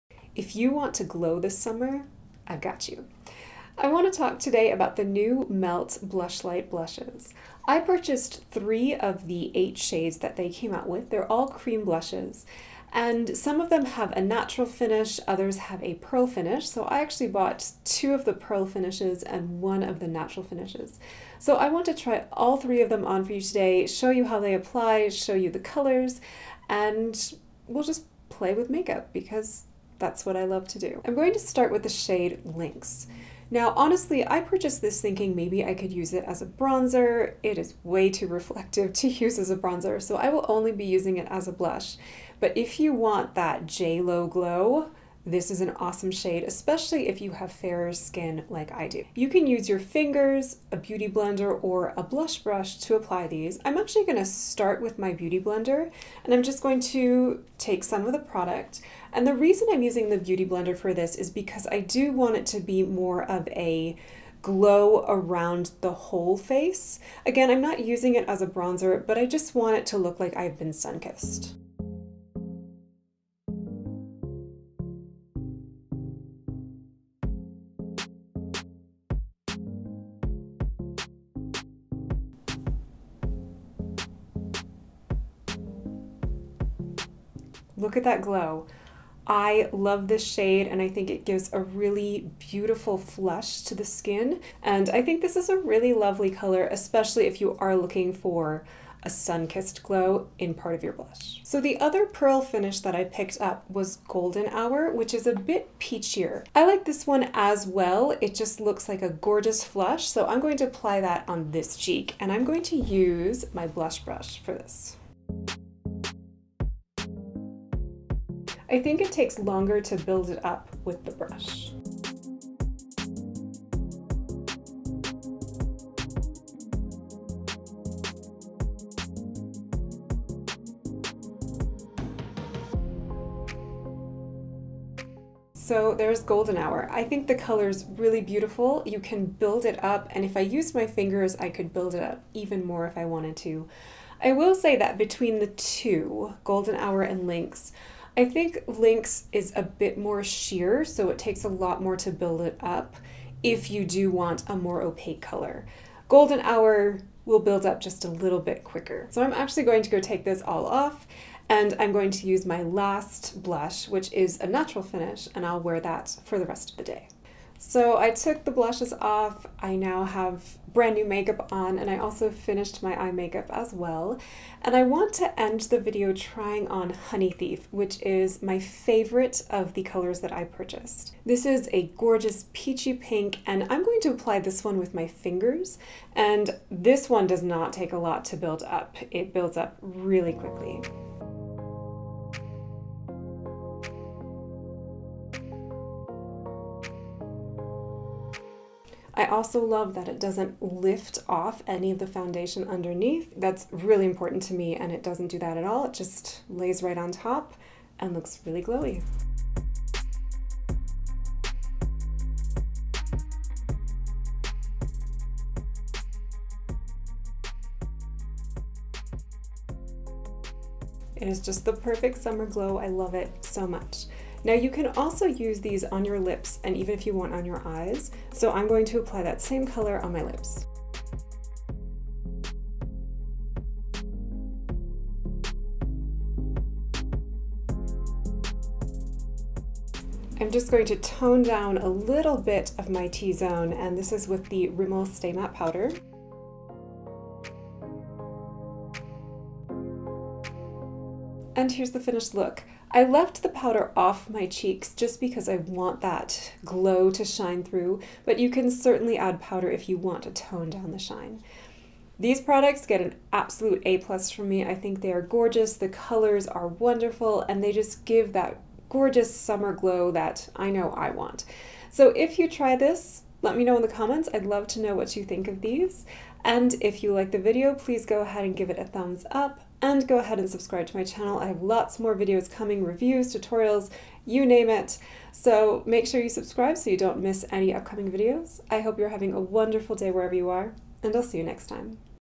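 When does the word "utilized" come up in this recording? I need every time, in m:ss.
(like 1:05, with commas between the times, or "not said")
not said.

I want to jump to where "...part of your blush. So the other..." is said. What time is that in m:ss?
1:40.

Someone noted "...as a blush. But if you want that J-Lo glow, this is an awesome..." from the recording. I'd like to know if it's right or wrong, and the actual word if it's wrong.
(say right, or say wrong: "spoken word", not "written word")
right.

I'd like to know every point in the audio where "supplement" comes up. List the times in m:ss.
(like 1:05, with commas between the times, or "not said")
not said.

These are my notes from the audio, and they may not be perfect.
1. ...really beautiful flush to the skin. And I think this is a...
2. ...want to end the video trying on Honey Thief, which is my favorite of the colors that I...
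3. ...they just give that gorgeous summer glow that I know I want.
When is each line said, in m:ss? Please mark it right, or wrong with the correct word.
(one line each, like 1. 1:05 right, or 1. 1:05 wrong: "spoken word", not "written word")
1. 1:31 right
2. 2:54 right
3. 4:27 right.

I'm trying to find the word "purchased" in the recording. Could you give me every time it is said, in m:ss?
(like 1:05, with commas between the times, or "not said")
0:07, 0:34, 3:00.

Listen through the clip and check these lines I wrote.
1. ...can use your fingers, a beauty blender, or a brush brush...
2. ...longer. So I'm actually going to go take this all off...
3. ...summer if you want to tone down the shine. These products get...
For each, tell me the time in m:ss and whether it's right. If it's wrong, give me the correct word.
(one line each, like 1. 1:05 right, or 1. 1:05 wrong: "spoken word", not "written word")
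1. 0:49 wrong: "blush", not "brush"
2. 2:38 wrong: "quicker", not "longer"
3. 4:19 wrong: "powder", not "summer".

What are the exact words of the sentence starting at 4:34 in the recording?
I'd love to know what you think of these.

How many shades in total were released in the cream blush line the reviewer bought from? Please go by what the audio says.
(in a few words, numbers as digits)
8.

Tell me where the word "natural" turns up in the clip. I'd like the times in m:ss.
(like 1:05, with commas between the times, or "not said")
0:14, 0:20, 2:44.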